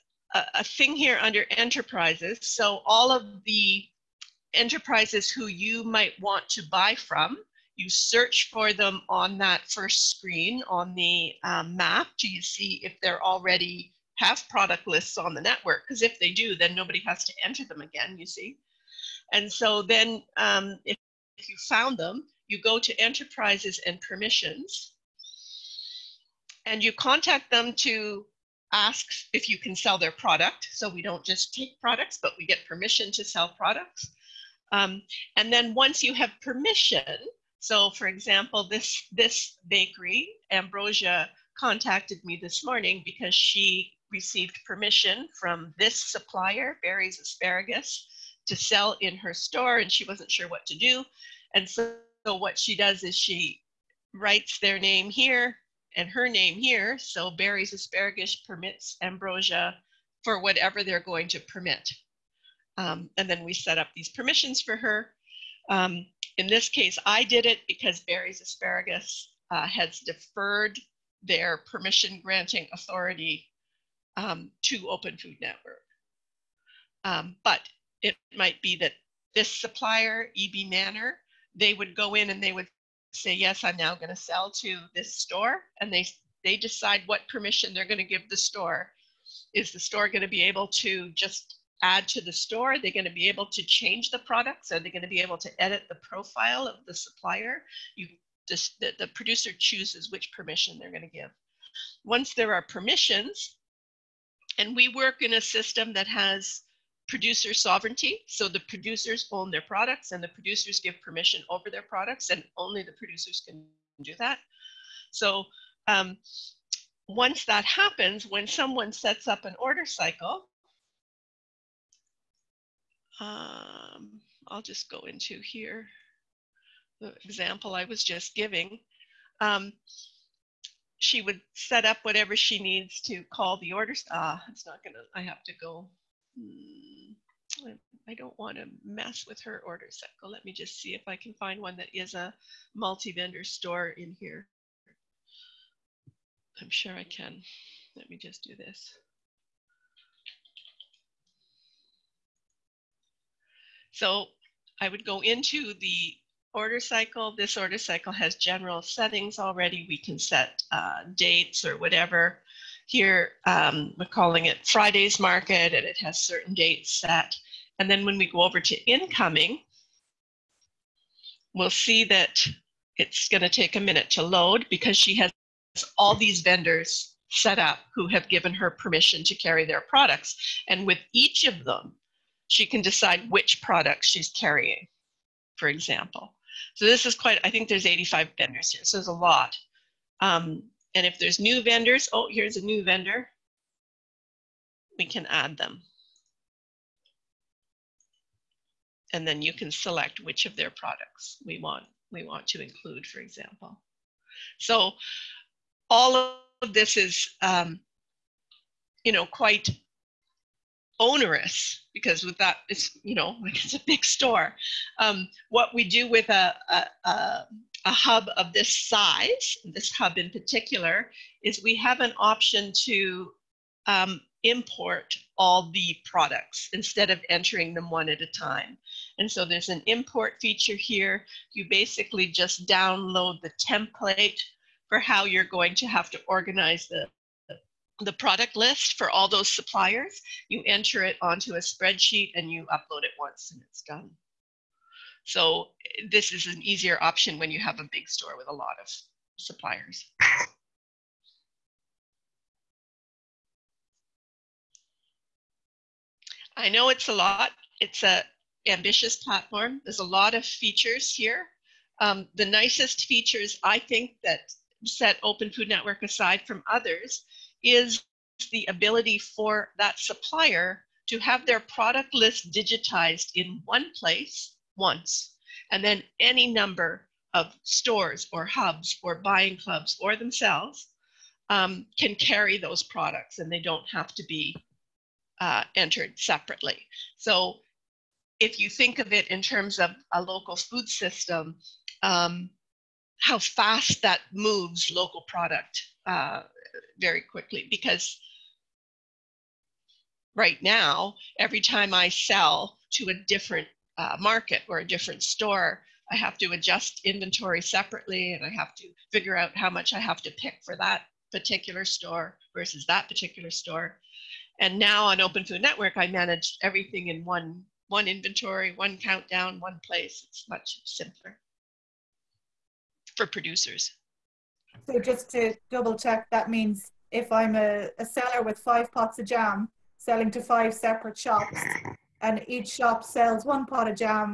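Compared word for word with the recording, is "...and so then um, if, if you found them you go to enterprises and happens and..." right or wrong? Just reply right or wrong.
wrong.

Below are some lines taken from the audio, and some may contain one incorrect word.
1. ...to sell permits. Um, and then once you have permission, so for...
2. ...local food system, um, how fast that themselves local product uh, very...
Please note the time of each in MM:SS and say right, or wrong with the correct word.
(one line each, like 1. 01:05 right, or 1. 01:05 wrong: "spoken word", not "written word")
1. 00:33 wrong: "products", not "permits"
2. 04:50 wrong: "moves", not "themselves".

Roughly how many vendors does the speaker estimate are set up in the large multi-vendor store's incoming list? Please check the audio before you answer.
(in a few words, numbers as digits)
85.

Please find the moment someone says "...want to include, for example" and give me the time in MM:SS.
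03:22.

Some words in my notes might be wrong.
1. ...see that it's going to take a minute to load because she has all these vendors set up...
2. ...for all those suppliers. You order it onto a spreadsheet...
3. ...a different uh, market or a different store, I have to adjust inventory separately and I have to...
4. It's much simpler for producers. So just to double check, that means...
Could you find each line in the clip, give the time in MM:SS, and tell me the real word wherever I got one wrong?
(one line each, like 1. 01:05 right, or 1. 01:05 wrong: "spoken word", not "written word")
1. 02:51 right
2. 03:58 wrong: "enter", not "order"
3. 05:03 right
4. 05:20 right.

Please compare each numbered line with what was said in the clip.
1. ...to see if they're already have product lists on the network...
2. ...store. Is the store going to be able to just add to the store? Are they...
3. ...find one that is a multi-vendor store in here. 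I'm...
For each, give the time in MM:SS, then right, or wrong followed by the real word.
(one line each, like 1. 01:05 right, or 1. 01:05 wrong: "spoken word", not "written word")
1. 00:12 right
2. 01:28 right
3. 02:21 right.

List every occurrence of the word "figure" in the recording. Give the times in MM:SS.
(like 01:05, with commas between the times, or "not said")
05:09.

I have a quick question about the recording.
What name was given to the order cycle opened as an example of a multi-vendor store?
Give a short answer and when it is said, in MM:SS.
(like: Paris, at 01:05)
Friday's Market, at 02:44.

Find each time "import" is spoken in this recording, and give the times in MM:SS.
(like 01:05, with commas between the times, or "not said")
03:44, 03:49.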